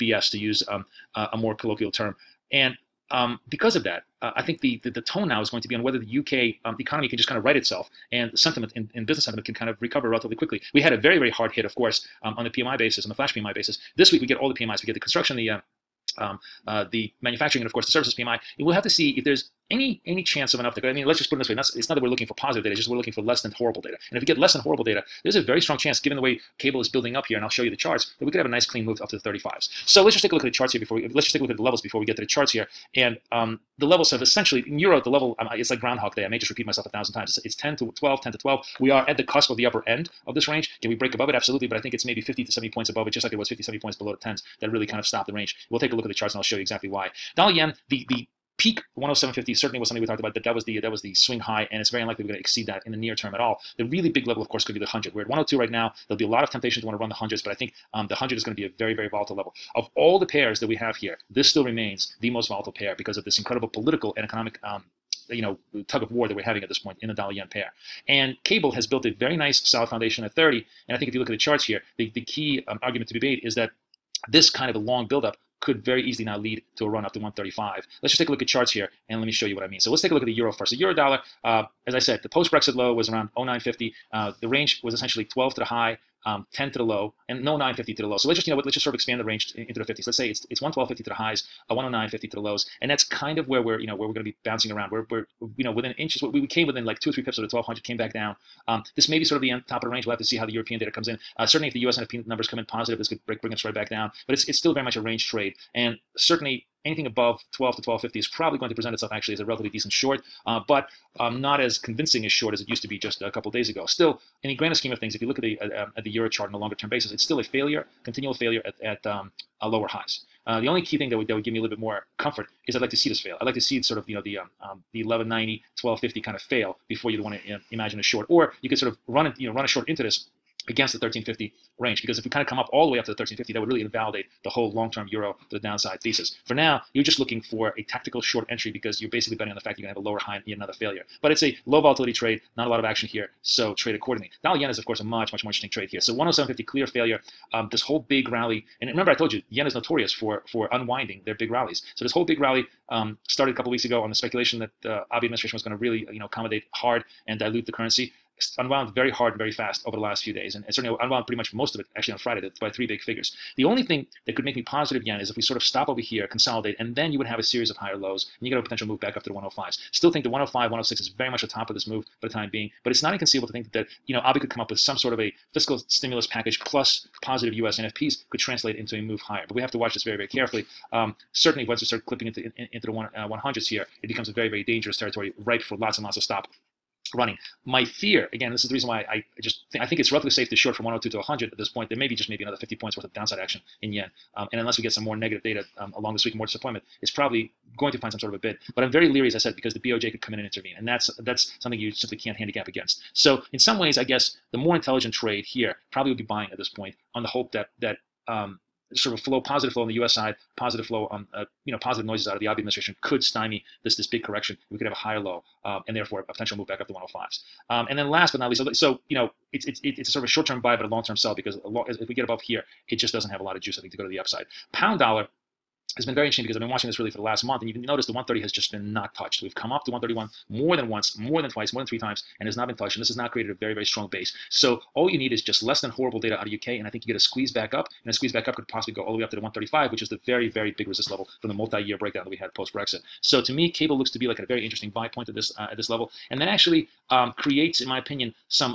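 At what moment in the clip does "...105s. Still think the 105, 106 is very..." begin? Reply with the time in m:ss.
2:49.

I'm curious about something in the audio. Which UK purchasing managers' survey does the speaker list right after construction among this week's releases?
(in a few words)
manufacturing.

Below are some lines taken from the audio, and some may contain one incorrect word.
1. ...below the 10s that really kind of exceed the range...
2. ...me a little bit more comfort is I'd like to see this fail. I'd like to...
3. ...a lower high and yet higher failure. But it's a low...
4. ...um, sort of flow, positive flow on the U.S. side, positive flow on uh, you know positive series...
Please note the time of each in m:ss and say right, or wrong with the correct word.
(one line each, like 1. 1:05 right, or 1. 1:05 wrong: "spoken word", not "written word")
1. 0:43 wrong: "stopped", not "exceed"
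2. 2:01 right
3. 2:20 wrong: "another", not "higher"
4. 3:28 wrong: "noises", not "series".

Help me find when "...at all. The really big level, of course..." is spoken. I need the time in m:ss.
0:53.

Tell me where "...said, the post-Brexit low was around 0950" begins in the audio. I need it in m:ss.
1:21.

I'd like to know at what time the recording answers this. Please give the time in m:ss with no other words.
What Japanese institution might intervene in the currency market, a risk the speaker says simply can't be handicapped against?
3:19.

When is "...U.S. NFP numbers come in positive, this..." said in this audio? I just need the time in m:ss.
1:41.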